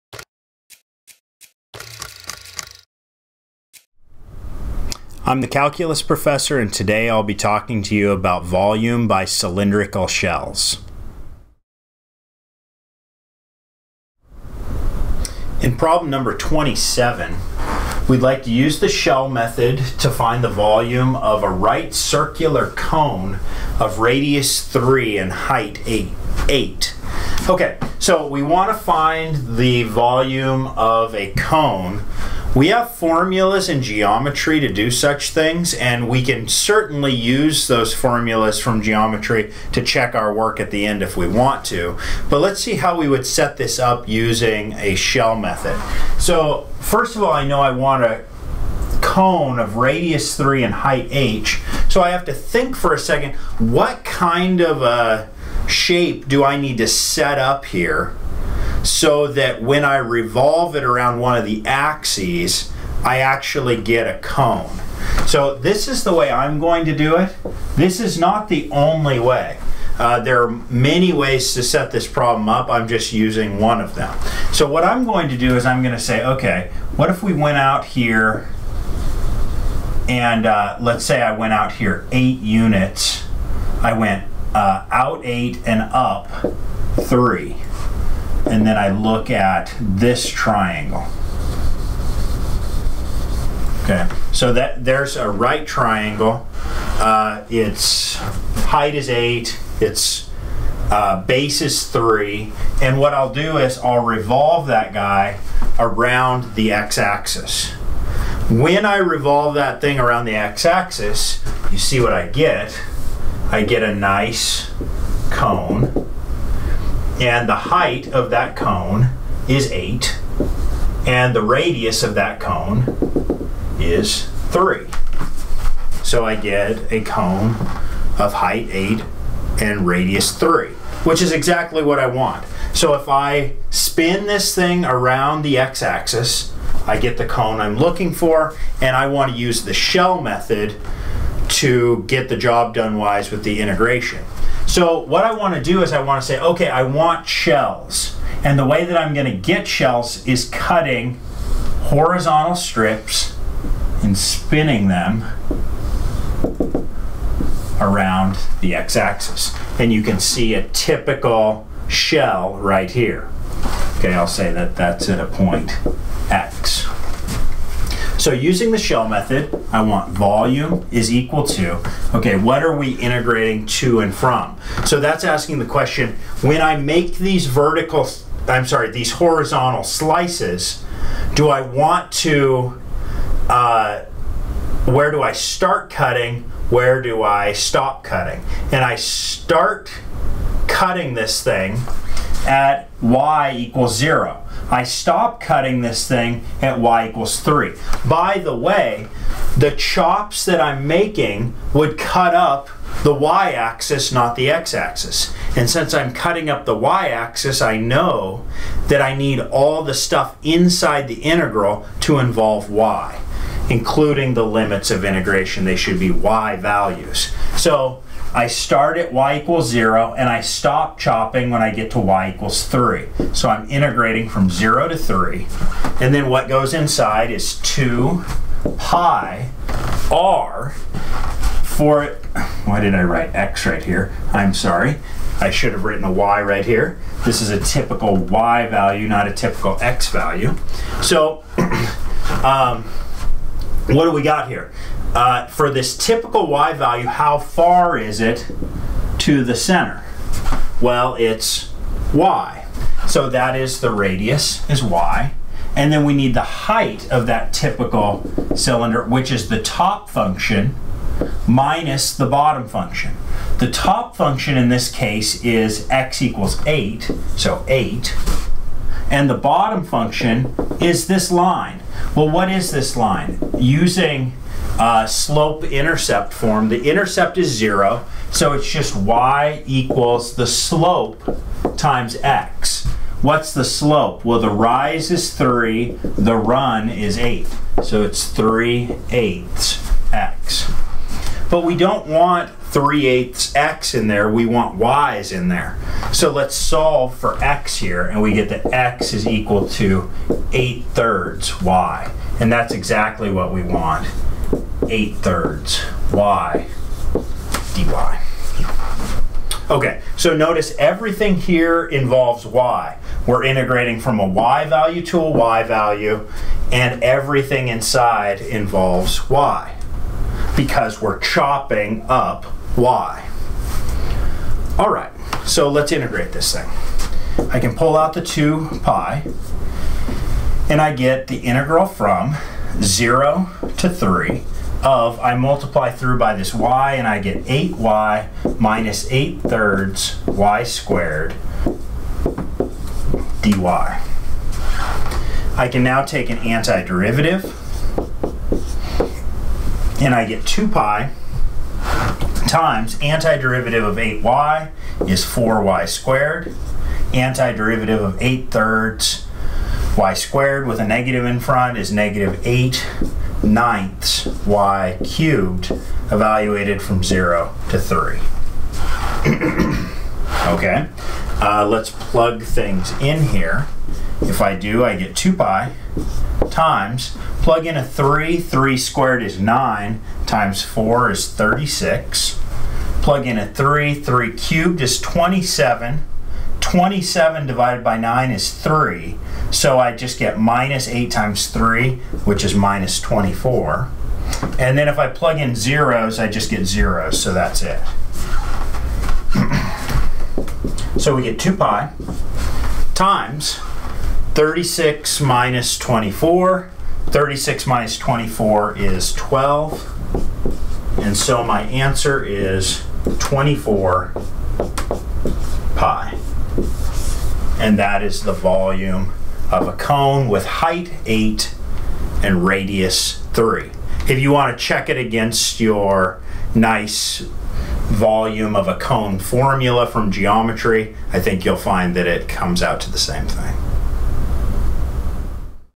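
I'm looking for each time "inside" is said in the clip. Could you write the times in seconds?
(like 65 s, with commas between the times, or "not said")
210 s, 226 s, 317 s.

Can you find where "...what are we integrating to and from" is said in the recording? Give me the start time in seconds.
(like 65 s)
172 s.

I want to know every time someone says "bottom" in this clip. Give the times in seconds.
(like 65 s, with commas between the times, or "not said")
262 s, 269 s.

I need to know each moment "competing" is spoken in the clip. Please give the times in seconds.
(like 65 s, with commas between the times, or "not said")
not said.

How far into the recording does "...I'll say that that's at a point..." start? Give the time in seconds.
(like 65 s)
164 s.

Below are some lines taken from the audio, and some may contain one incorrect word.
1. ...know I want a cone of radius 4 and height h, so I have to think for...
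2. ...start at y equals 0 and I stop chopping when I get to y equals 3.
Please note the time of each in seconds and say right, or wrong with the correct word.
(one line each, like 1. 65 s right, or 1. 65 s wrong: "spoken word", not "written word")
1. 47 s wrong: "3", not "4"
2. 218 s right.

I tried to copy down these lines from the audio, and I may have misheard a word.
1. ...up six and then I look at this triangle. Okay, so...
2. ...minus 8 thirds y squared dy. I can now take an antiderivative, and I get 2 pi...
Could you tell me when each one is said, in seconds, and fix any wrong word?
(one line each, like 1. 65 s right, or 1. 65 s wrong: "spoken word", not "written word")
1. 85 s wrong: "three", not "six"
2. 338 s right.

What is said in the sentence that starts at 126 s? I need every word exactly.
So I get a cone of height 8 and radius 3, which is exactly what I want.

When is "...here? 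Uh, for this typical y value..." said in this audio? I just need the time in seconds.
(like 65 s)
244 s.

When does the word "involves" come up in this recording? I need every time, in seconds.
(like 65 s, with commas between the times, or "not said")
212 s, 311 s, 318 s.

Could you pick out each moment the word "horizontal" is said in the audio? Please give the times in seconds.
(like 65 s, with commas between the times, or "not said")
151 s, 179 s.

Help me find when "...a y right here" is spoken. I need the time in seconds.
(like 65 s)
236 s.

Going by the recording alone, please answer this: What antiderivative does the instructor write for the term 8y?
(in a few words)
4y squared.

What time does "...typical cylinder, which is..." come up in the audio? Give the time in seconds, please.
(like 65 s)
257 s.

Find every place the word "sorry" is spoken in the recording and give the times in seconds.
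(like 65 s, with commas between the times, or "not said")
178 s, 234 s.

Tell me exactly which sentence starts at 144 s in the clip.
So what I want to do is I want to say, okay, I want shells.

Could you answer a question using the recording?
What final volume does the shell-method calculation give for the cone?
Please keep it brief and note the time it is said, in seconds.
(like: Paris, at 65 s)
24 pi, at 413 s.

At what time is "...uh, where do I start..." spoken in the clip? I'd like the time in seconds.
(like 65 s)
183 s.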